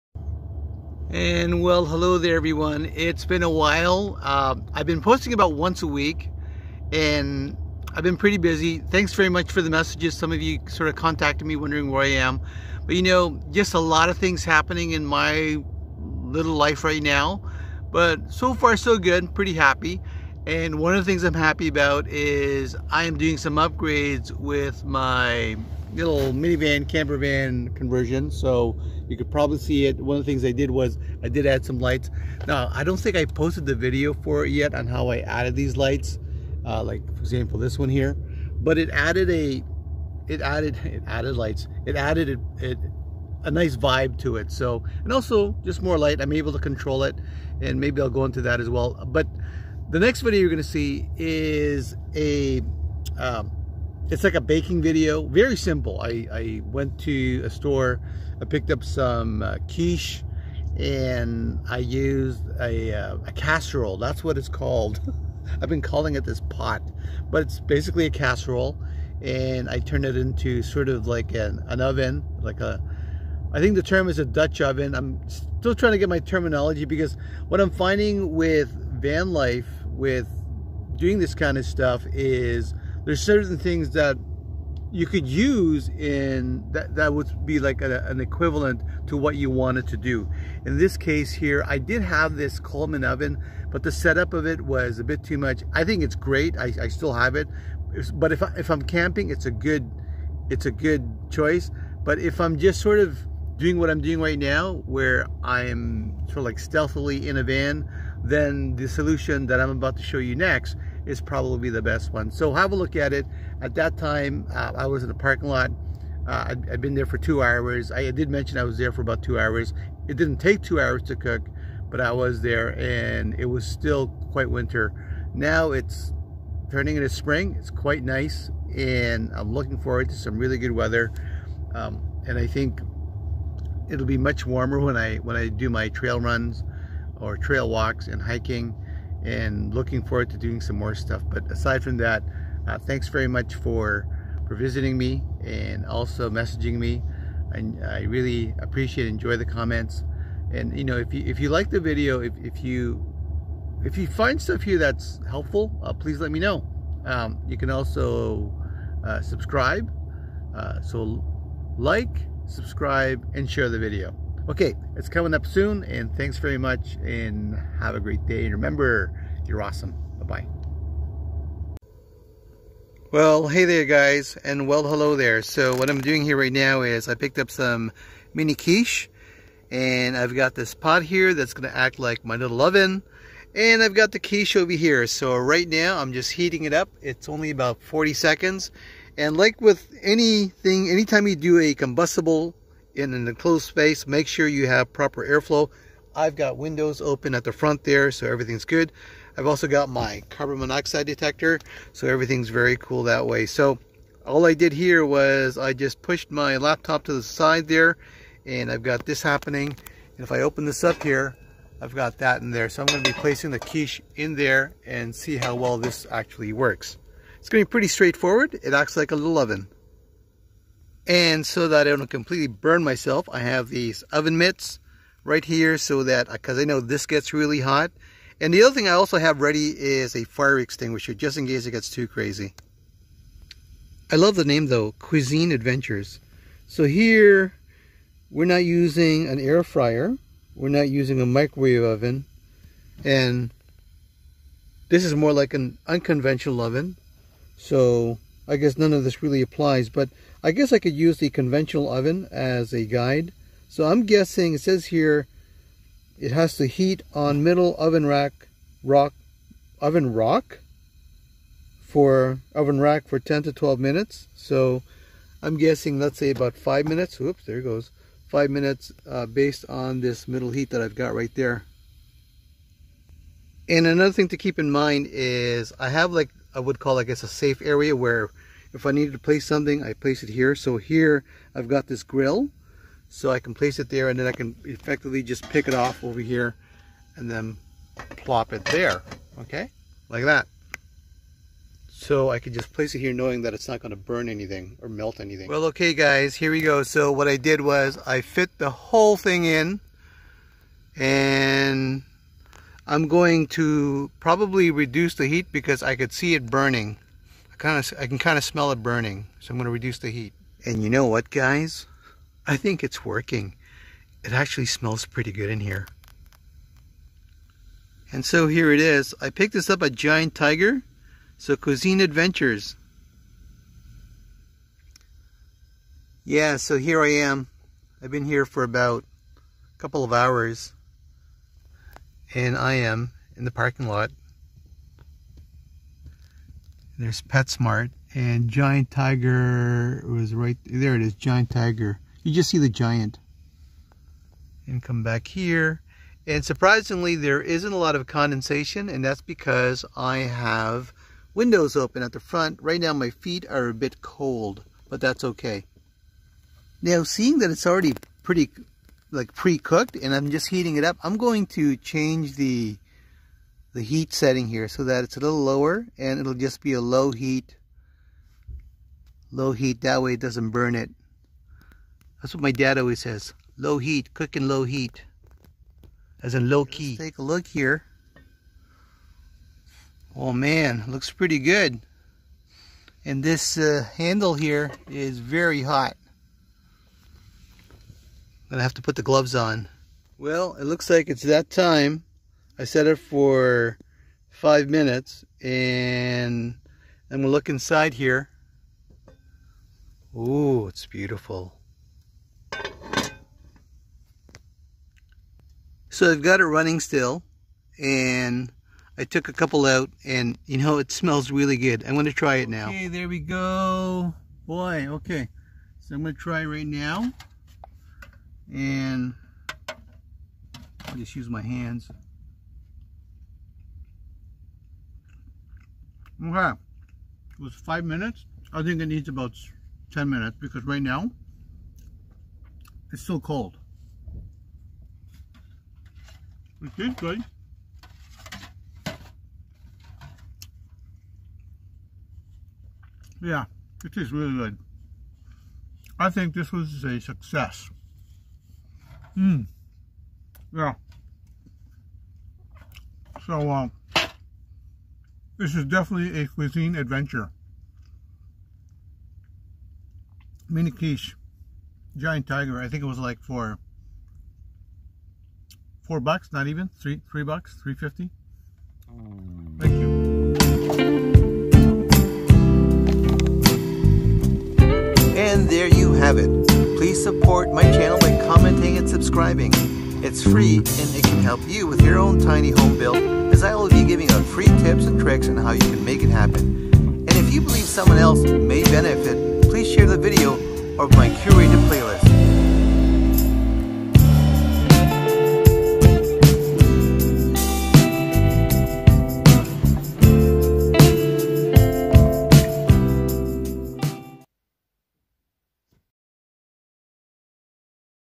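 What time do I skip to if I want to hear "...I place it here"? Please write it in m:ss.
4:39.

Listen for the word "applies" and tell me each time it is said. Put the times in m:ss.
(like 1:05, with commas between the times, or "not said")
4:09.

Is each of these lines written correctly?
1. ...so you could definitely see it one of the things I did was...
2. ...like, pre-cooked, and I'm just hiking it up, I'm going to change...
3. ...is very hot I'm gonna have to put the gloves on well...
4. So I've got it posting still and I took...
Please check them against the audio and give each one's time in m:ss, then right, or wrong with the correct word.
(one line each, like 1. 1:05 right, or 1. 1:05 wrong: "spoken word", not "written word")
1. 0:28 wrong: "probably", not "definitely"
2. 5:59 wrong: "heating", not "hiking"
3. 6:24 right
4. 6:45 wrong: "running", not "posting".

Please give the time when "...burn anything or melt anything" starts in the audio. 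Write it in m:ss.
4:53.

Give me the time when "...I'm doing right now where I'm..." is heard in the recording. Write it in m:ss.
1:43.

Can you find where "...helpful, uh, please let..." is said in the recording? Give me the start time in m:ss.
2:35.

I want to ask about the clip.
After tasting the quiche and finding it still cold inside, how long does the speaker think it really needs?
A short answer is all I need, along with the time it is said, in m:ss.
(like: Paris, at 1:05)
10 minutes, at 7:09.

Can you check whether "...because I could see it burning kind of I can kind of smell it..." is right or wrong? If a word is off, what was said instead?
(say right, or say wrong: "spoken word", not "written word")
right.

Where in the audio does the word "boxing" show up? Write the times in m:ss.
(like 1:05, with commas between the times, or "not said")
not said.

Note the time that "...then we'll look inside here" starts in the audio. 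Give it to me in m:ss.
6:37.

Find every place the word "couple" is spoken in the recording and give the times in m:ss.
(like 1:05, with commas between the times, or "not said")
5:29, 6:49.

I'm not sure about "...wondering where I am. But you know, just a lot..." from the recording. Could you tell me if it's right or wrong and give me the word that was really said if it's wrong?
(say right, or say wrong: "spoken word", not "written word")
right.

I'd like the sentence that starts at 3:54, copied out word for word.
I love the name though, Cuisine Adventures.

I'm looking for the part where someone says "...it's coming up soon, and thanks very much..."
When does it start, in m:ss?
2:44.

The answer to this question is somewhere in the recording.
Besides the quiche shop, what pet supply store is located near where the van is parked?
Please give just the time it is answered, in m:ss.
5:37.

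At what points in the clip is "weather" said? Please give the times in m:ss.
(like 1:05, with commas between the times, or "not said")
2:10.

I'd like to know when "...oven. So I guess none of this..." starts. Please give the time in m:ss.
4:06.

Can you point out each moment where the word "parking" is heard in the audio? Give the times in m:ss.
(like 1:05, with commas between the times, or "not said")
1:55, 5:33.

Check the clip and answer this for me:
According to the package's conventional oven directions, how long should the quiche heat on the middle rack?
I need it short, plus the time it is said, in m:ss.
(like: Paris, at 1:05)
10 to 12 minutes, at 4:23.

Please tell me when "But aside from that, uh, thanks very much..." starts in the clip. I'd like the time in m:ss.
2:21.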